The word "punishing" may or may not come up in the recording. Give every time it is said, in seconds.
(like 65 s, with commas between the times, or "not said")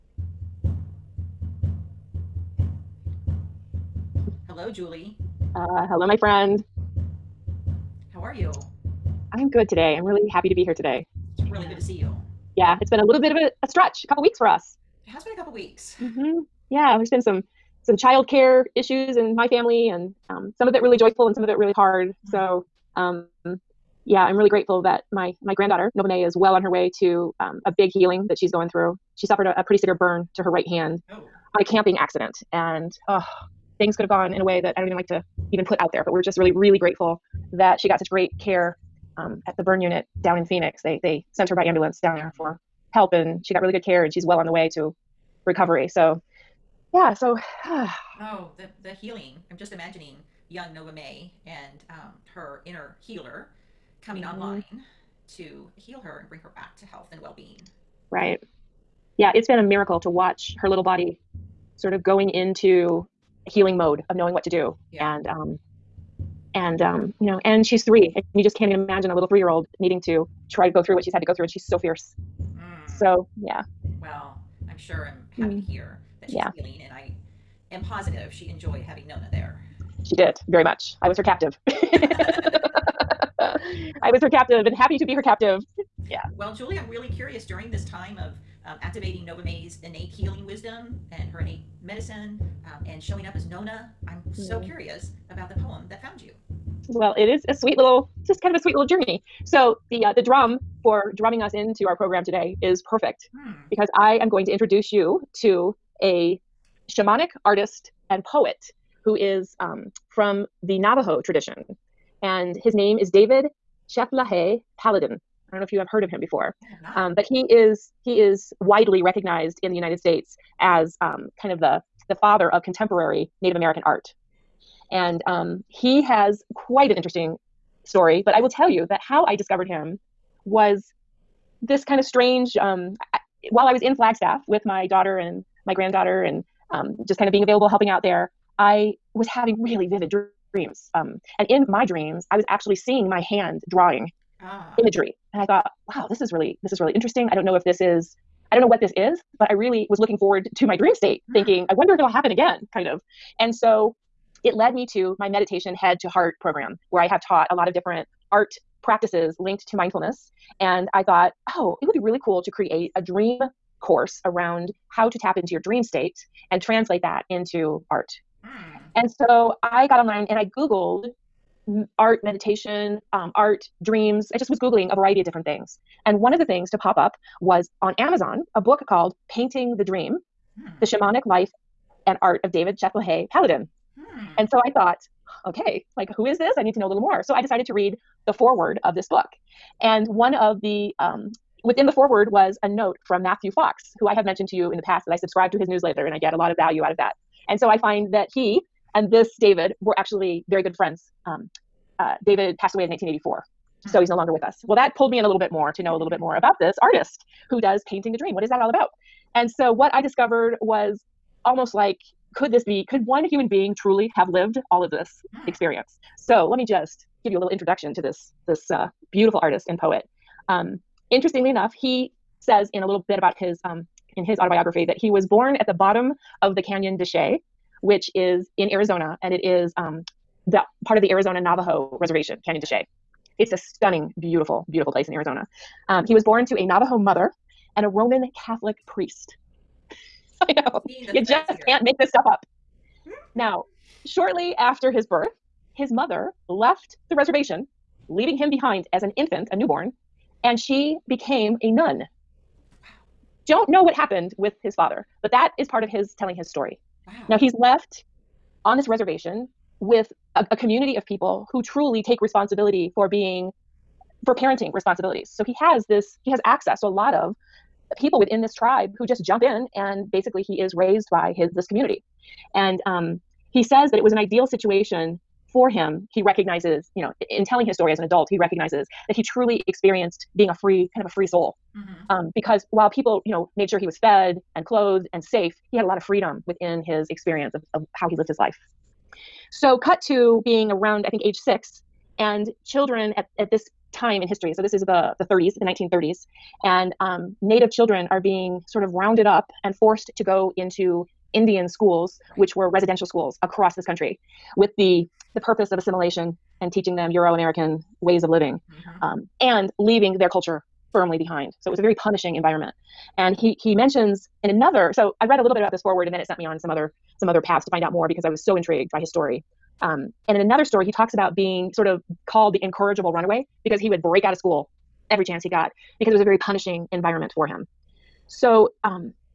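311 s, 326 s.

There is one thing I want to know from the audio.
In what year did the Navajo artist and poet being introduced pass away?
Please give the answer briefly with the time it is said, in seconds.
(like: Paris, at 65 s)
1984, at 202 s.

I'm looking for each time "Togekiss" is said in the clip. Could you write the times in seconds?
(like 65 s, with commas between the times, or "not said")
not said.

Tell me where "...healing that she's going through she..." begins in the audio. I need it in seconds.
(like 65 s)
27 s.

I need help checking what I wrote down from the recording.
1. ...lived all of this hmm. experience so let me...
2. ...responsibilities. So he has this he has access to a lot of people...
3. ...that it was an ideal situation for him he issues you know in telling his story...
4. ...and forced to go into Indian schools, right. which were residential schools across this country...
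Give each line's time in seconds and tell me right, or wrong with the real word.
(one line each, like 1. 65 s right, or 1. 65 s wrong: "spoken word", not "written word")
1. 214 s right
2. 264 s right
3. 273 s wrong: "recognizes", not "issues"
4. 299 s right.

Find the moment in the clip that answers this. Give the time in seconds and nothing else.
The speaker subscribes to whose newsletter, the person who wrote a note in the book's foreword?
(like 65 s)
193 s.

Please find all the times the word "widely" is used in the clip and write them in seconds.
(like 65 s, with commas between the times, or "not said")
118 s.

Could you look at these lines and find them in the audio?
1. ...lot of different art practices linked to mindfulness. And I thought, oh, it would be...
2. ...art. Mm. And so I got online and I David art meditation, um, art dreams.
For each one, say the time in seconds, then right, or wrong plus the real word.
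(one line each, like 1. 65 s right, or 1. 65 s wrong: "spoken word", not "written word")
1. 157 s right
2. 167 s wrong: "Googled", not "David".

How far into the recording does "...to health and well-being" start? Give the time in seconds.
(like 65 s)
56 s.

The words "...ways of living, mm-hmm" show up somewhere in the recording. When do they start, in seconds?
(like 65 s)
308 s.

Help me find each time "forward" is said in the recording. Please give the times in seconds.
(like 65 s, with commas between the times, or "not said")
150 s, 315 s.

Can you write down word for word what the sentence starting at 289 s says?
So, cut to being around, I think, age six, and children at, at this time in history.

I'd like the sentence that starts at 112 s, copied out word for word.
And his name is David Chethlahe Paladin.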